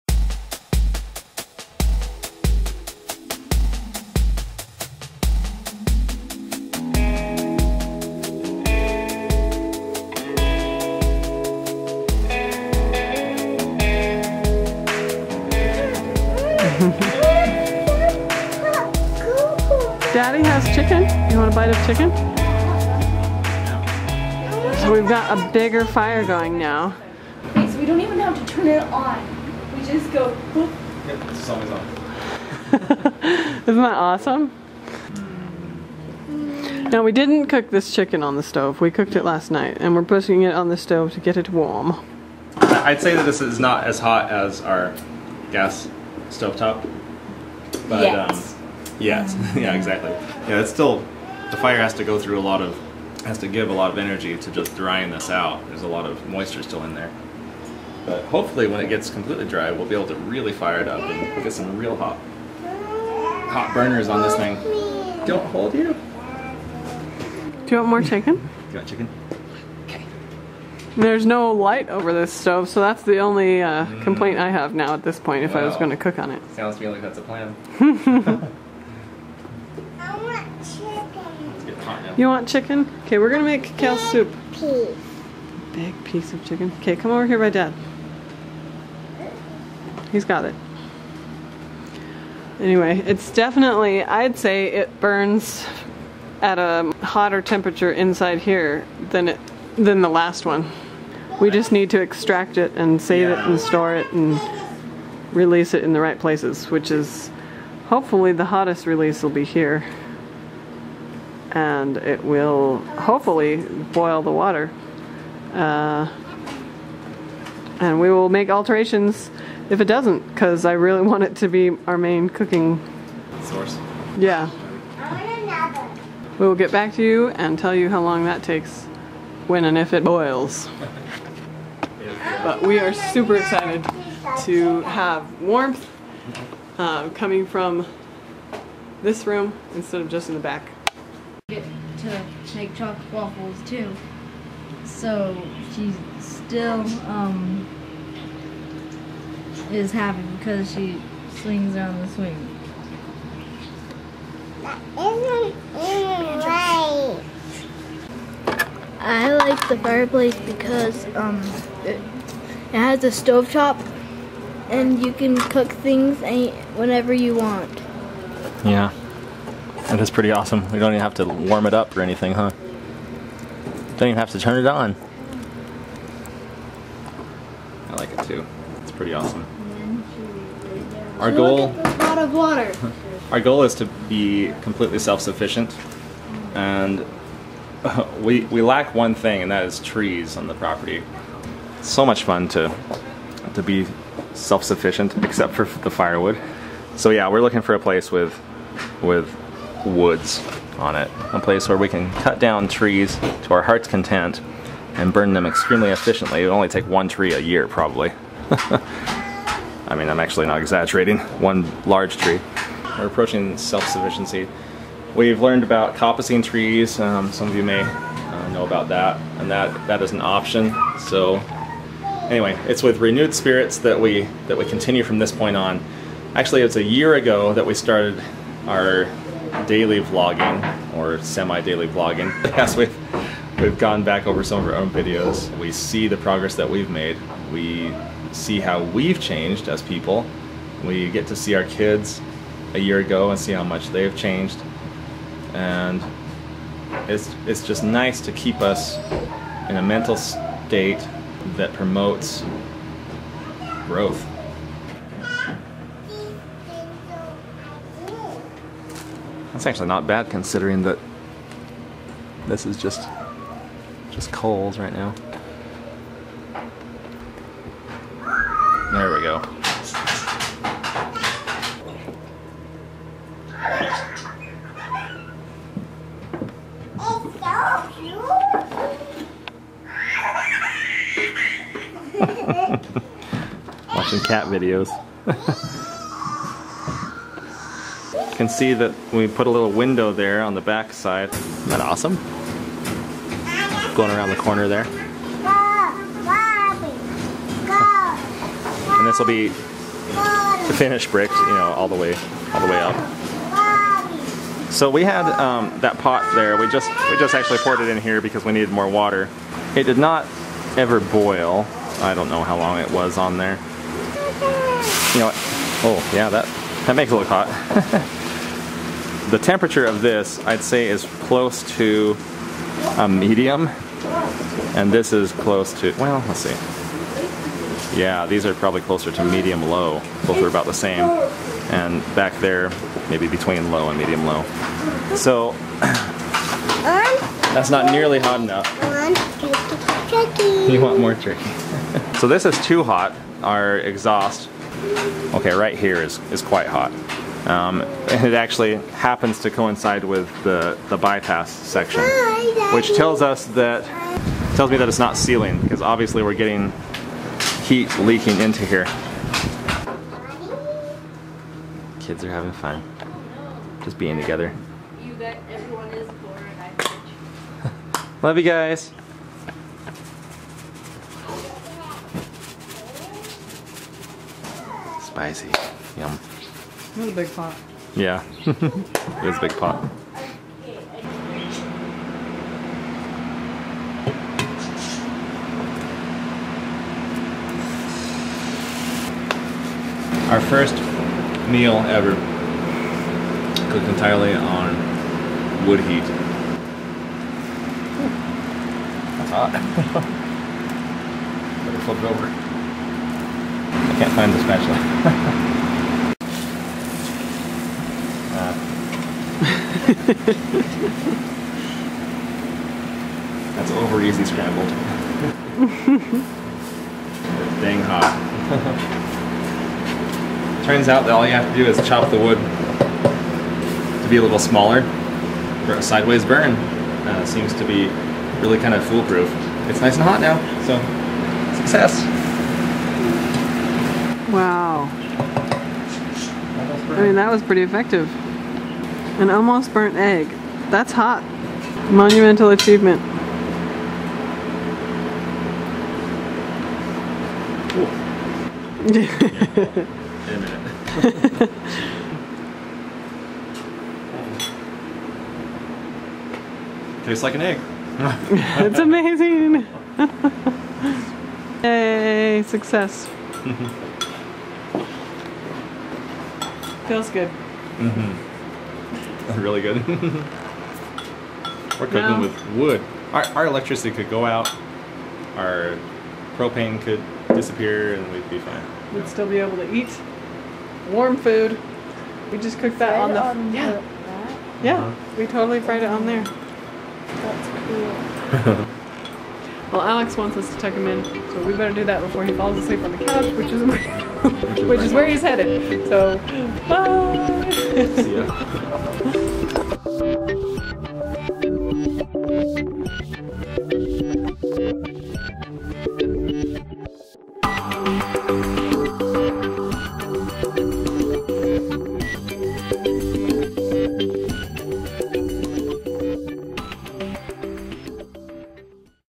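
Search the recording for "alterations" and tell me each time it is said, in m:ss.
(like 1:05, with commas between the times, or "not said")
1:58.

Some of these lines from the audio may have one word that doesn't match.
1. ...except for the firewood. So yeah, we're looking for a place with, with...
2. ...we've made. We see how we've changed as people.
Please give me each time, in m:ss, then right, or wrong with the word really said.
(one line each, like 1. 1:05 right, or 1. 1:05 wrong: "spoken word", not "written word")
1. 3:15 right
2. 3:56 right.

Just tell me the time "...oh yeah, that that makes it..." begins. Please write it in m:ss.
5:15.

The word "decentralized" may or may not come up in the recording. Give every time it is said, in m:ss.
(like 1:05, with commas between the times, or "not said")
not said.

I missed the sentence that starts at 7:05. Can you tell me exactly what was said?
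for A sideways burn uh, seems to be really kind of foolproof.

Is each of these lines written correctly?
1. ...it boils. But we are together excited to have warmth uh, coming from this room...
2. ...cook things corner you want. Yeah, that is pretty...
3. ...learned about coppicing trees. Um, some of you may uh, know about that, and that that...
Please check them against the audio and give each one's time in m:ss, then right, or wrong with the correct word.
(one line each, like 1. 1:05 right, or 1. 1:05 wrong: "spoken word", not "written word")
1. 2:09 wrong: "super", not "together"
2. 2:45 wrong: "whenever", not "corner"
3. 3:35 right.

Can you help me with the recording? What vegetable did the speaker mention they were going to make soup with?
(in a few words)
Kale.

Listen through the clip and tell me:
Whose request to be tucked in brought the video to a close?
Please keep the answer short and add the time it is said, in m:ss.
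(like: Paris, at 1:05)
Alex, at 8:09.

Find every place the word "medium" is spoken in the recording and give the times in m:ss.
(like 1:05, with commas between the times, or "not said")
5:23, 5:29, 5:33.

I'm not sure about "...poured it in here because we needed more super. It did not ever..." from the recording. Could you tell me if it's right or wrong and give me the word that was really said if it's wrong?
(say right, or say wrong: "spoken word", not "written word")
wrong: "water", not "super".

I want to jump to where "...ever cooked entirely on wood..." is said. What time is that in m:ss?
6:31.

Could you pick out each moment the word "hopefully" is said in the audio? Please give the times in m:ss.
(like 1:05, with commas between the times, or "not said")
0:58, 1:47, 1:52.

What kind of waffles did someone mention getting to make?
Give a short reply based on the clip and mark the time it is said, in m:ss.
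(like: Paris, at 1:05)
Chocolate waffles, at 2:22.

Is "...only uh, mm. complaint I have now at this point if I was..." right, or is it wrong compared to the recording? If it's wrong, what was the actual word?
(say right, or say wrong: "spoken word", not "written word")
right.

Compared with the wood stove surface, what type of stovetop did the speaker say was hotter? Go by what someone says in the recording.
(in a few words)
Gas stovetop.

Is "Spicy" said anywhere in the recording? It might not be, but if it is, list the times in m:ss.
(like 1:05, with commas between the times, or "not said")
6:15.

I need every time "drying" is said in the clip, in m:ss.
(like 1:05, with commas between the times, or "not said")
0:54.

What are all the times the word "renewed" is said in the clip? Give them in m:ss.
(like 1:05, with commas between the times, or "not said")
3:42.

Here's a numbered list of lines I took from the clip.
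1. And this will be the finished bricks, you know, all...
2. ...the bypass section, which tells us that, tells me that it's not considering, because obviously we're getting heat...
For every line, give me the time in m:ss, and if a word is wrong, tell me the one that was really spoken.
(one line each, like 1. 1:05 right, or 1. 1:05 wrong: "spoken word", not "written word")
1. 4:58 right
2. 5:50 wrong: "sealing", not "considering".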